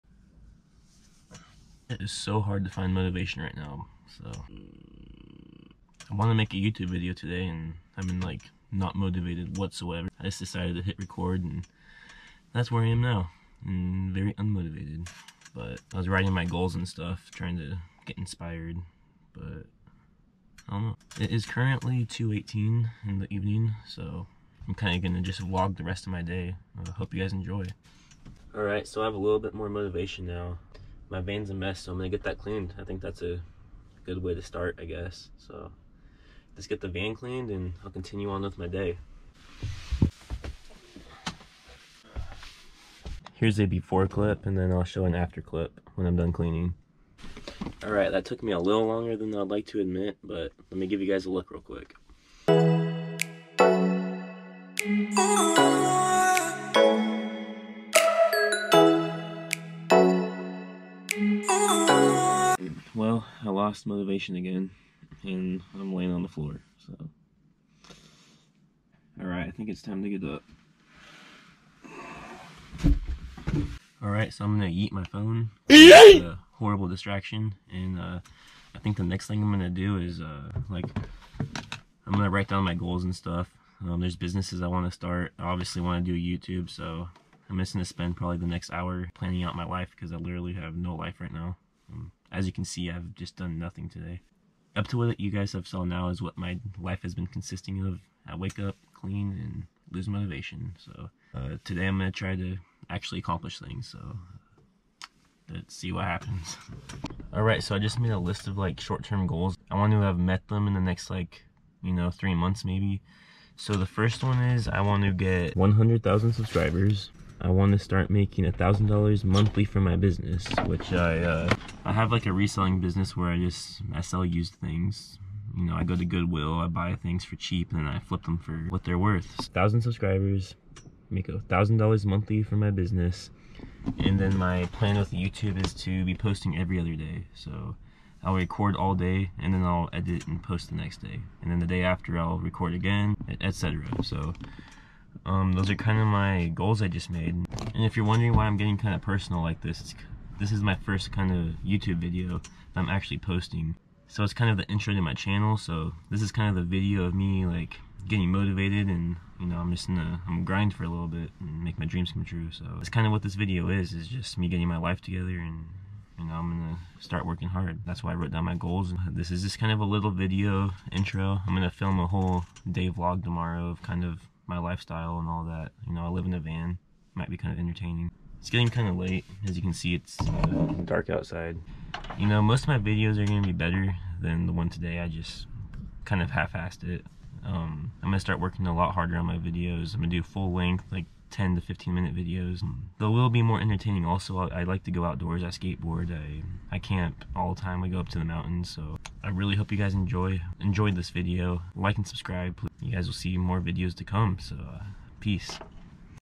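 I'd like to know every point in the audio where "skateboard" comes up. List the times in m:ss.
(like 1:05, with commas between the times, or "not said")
3:15.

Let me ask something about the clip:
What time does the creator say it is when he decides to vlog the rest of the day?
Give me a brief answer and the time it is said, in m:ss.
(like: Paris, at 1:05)
2:18, at 0:22.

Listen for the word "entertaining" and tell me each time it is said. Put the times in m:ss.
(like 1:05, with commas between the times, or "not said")
2:57, 3:13.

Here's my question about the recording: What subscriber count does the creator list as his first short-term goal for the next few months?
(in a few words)
100,000.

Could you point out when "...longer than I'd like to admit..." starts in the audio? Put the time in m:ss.
0:48.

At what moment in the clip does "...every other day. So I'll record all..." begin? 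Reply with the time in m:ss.
2:16.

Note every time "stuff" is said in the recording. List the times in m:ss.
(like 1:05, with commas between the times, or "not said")
0:16, 1:23.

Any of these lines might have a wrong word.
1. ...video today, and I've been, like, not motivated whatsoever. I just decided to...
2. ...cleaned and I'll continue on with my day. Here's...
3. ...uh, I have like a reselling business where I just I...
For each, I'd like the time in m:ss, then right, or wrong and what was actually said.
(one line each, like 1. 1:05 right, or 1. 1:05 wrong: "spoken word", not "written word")
1. 0:06 right
2. 0:37 right
3. 2:01 right.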